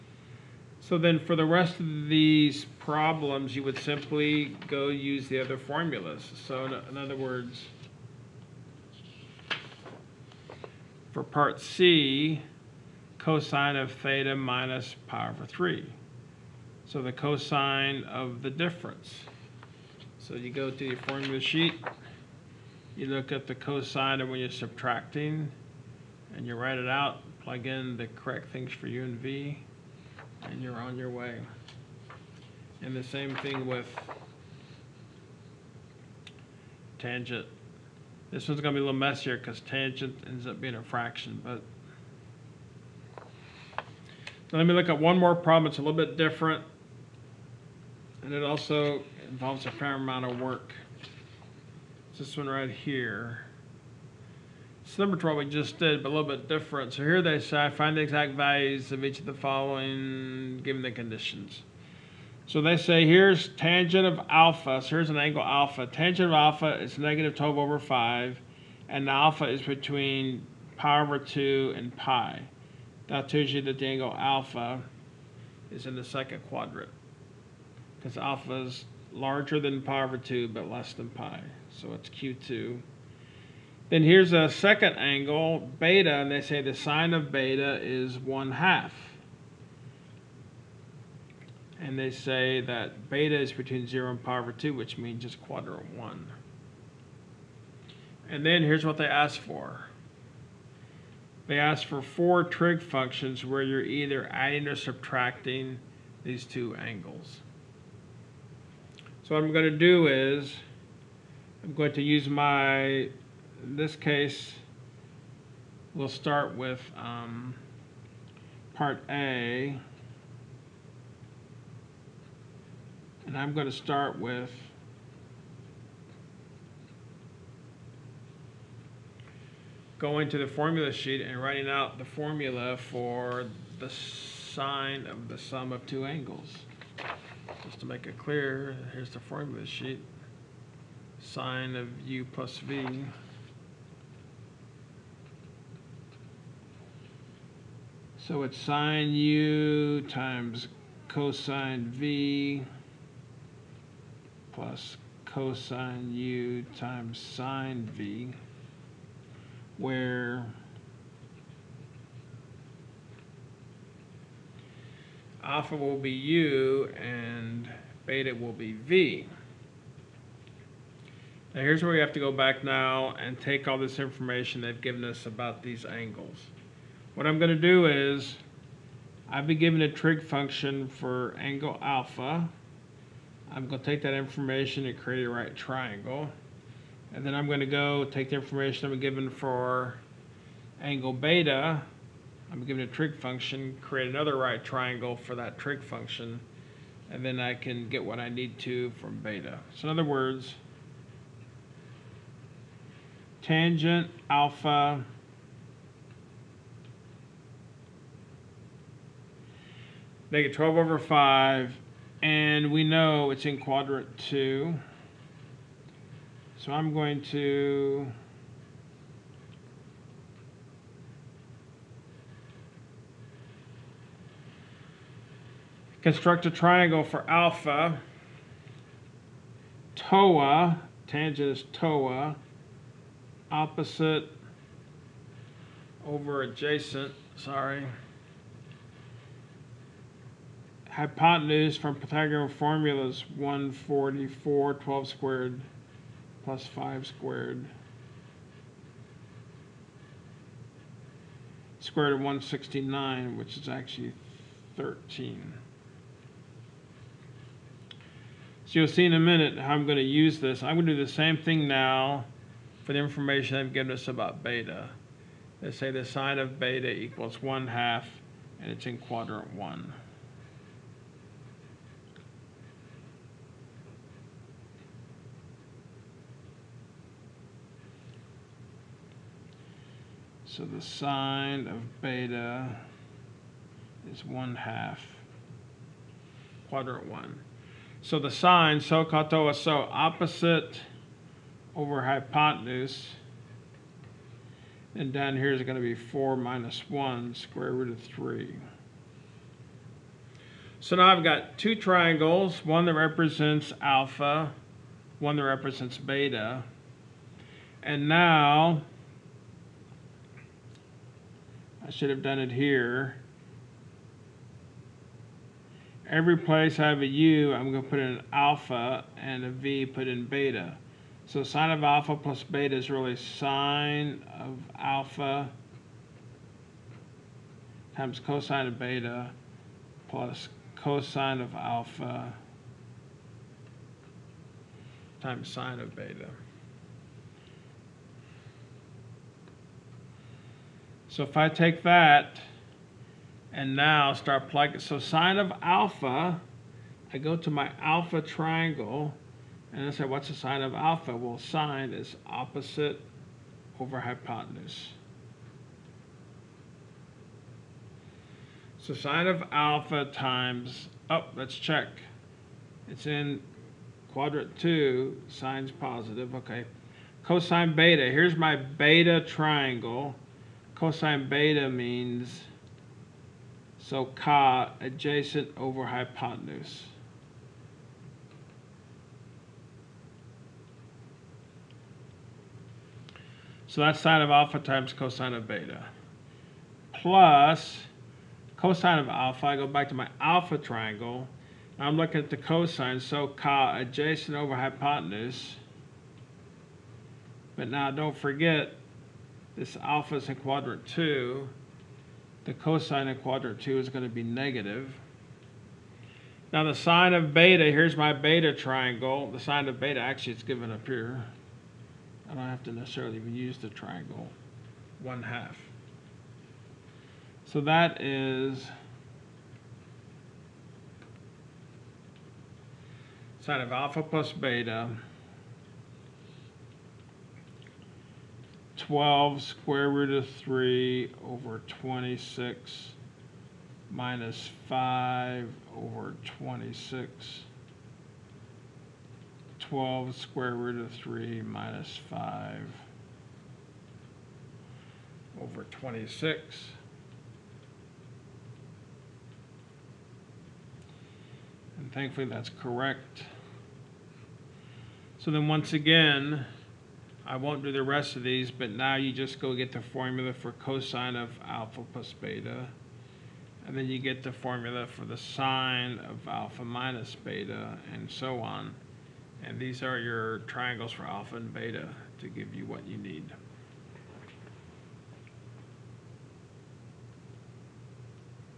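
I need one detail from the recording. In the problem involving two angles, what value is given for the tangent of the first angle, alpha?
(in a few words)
-12/5.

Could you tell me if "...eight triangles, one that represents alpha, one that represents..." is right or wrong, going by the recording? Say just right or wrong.
wrong.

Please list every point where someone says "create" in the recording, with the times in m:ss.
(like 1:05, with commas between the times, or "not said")
3:04, 3:13.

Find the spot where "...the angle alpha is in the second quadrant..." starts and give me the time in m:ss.
1:13.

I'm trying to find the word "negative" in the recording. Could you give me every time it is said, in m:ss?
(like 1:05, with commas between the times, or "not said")
1:06, 6:44.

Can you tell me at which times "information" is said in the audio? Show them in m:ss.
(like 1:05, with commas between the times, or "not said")
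2:53, 3:04, 3:08, 4:22.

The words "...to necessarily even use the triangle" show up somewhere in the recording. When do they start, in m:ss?
6:52.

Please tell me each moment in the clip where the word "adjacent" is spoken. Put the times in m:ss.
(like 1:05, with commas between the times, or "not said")
3:56, 6:14, 6:33.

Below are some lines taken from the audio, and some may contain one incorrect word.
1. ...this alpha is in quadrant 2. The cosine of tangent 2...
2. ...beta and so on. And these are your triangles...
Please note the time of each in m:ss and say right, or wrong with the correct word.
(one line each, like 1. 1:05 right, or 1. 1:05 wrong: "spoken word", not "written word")
1. 6:39 wrong: "quadrant", not "tangent"
2. 7:47 right.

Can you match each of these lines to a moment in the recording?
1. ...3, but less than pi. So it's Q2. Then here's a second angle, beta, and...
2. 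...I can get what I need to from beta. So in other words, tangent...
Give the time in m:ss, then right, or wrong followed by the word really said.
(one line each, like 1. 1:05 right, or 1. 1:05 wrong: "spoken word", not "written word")
1. 1:20 wrong: "2", not "3"
2. 3:17 right.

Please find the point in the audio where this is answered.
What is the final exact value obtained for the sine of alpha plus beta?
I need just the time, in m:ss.
7:19.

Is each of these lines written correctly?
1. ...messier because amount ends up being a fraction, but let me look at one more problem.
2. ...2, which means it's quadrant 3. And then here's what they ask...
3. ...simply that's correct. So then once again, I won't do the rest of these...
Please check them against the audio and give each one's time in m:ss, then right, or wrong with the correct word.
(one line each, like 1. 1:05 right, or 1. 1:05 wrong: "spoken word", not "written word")
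1. 0:38 wrong: "tangent", not "amount"
2. 1:34 wrong: "1", not "3"
3. 7:31 wrong: "thankfully", not "simply".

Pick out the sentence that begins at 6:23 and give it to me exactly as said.
So that's sine of alpha times cosine of beta.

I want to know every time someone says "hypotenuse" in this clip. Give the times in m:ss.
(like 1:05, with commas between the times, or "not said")
4:00, 4:52, 5:53, 6:15, 6:34.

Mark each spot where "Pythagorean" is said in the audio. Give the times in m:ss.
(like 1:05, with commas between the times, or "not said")
4:01.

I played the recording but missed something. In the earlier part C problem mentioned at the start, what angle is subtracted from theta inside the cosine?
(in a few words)
pi/3.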